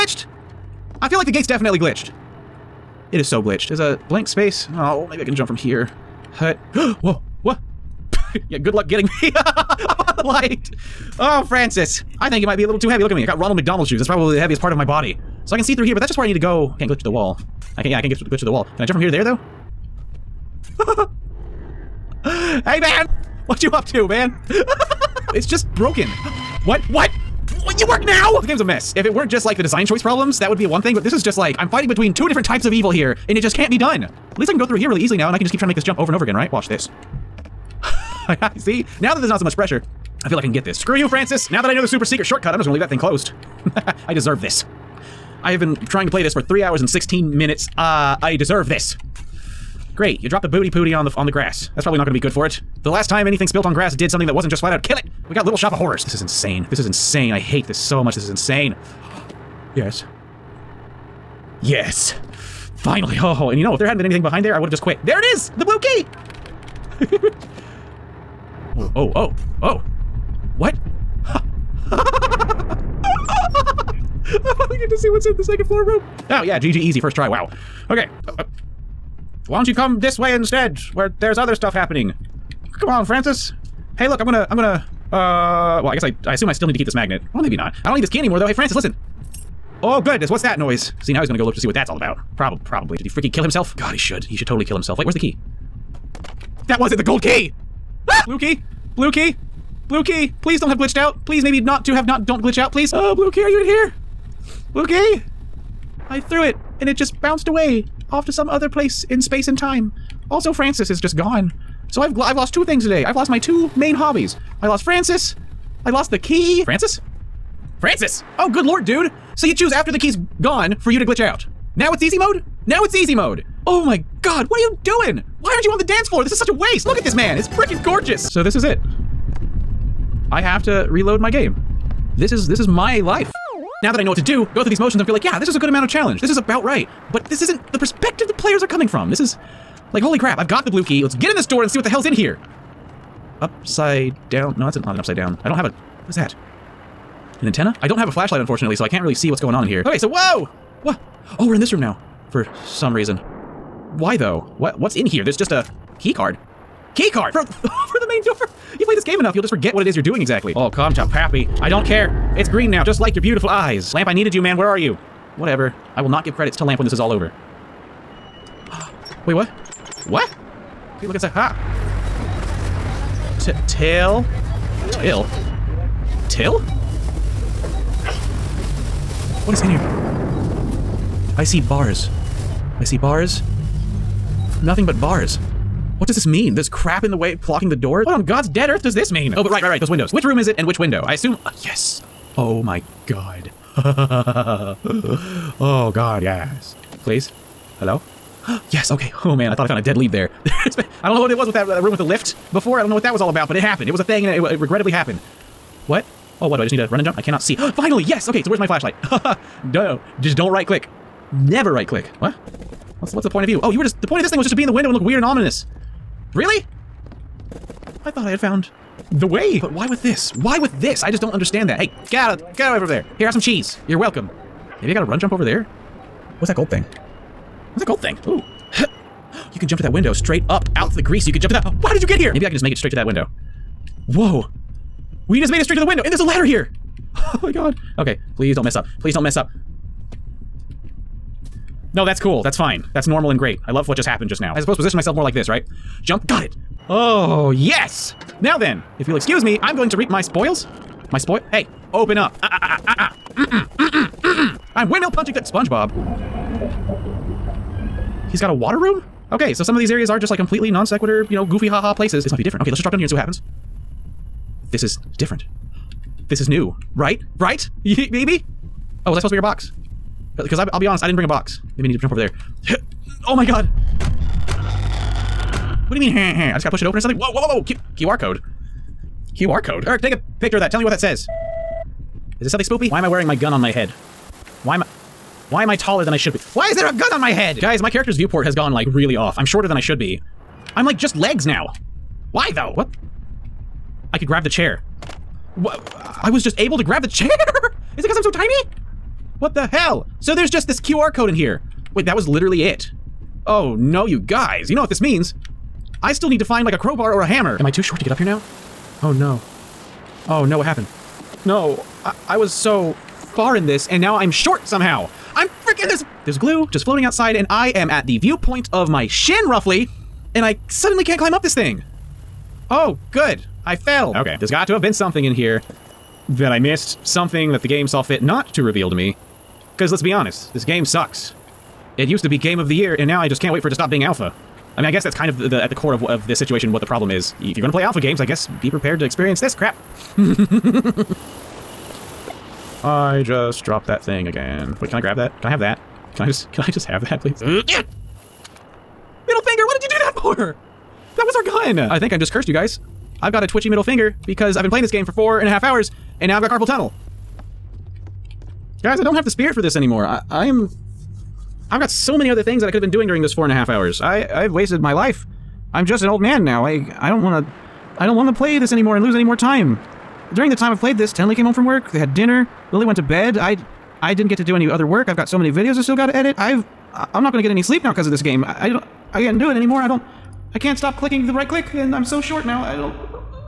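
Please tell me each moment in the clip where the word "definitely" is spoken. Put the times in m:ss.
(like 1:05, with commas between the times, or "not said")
0:01.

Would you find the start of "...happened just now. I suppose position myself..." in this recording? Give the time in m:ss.
4:04.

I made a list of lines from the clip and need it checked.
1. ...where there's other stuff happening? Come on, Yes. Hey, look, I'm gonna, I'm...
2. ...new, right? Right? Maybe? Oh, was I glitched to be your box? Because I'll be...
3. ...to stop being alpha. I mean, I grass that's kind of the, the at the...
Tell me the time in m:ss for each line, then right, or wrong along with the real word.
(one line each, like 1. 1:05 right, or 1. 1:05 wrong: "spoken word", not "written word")
1. 1:20 wrong: "Francis", not "Yes"
2. 4:26 wrong: "supposed", not "glitched"
3. 5:33 wrong: "guess", not "grass".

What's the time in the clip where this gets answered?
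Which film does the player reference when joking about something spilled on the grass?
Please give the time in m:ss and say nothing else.
0:55.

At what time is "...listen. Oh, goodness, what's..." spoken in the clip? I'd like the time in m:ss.
1:28.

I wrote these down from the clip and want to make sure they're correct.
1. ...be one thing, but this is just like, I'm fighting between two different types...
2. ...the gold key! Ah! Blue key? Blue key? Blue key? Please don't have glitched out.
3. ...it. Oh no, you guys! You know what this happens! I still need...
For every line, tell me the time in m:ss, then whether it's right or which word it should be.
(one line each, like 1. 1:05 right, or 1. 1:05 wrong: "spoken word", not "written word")
1. 0:30 right
2. 1:36 right
3. 5:02 wrong: "means", not "happens".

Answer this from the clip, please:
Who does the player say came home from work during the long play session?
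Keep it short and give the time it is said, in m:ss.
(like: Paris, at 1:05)
Tenley, at 6:11.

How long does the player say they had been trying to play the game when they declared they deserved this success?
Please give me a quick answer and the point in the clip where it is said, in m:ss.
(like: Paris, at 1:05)
3 hours and 16 minutes, at 0:46.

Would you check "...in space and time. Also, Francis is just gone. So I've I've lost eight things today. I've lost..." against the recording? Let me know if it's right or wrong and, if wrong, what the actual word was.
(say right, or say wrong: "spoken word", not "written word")
wrong: "two", not "eight".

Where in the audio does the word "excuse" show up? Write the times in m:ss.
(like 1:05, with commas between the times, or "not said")
4:09.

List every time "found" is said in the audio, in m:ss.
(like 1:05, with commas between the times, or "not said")
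3:19, 3:38.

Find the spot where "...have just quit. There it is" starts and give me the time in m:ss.
1:04.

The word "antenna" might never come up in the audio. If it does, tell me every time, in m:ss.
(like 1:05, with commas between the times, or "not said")
2:27.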